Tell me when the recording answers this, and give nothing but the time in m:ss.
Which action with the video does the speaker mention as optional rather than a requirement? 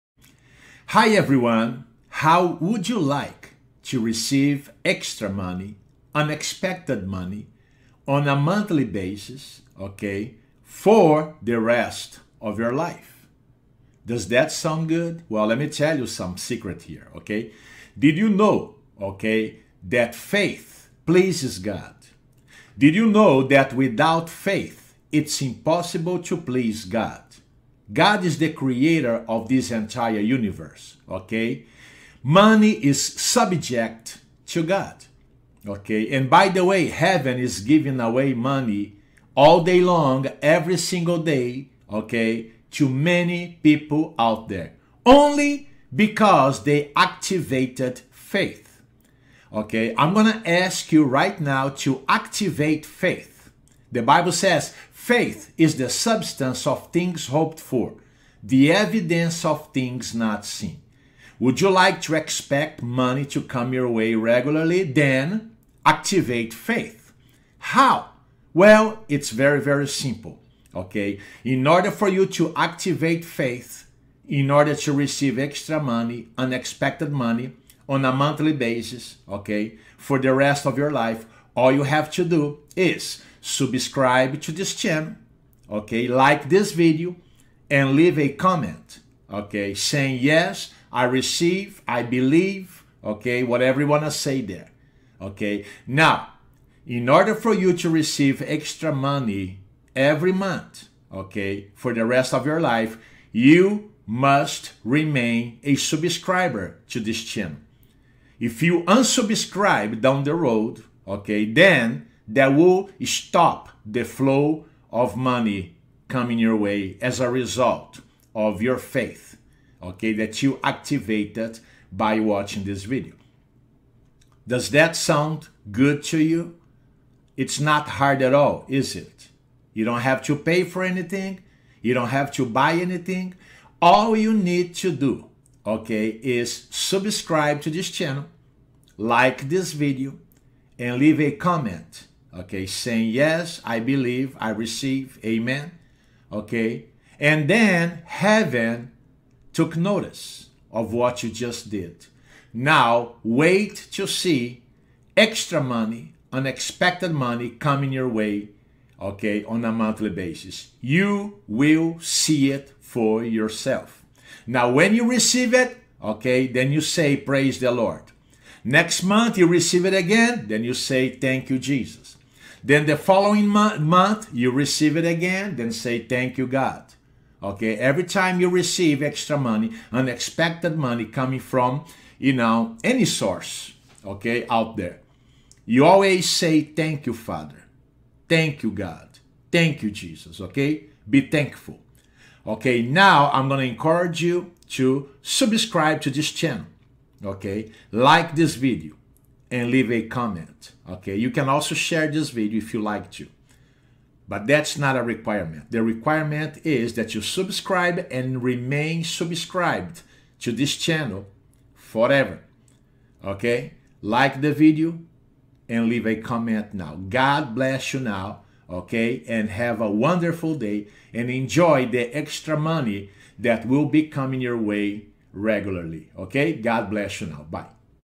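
3:21.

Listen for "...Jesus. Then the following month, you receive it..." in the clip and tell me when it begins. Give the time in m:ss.
2:51.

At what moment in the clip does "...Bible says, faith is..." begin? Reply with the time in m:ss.
0:54.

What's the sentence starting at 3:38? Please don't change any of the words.
Okay, and have a wonderful day and enjoy the extra money that will be coming your way regularly.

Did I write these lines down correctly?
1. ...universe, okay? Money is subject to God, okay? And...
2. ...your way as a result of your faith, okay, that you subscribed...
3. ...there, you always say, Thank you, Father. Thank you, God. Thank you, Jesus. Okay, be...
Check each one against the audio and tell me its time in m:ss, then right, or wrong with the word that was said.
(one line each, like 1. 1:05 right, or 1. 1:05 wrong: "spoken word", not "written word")
1. 0:30 right
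2. 1:56 wrong: "activated", not "subscribed"
3. 3:04 right.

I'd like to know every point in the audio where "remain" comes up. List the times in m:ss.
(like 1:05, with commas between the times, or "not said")
1:44, 3:28.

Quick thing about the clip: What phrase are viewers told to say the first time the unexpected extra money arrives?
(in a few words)
Praise the Lord.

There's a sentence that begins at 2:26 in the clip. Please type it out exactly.
Okay, and then heaven took notice of what you just did.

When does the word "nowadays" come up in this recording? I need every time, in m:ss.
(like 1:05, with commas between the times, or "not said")
not said.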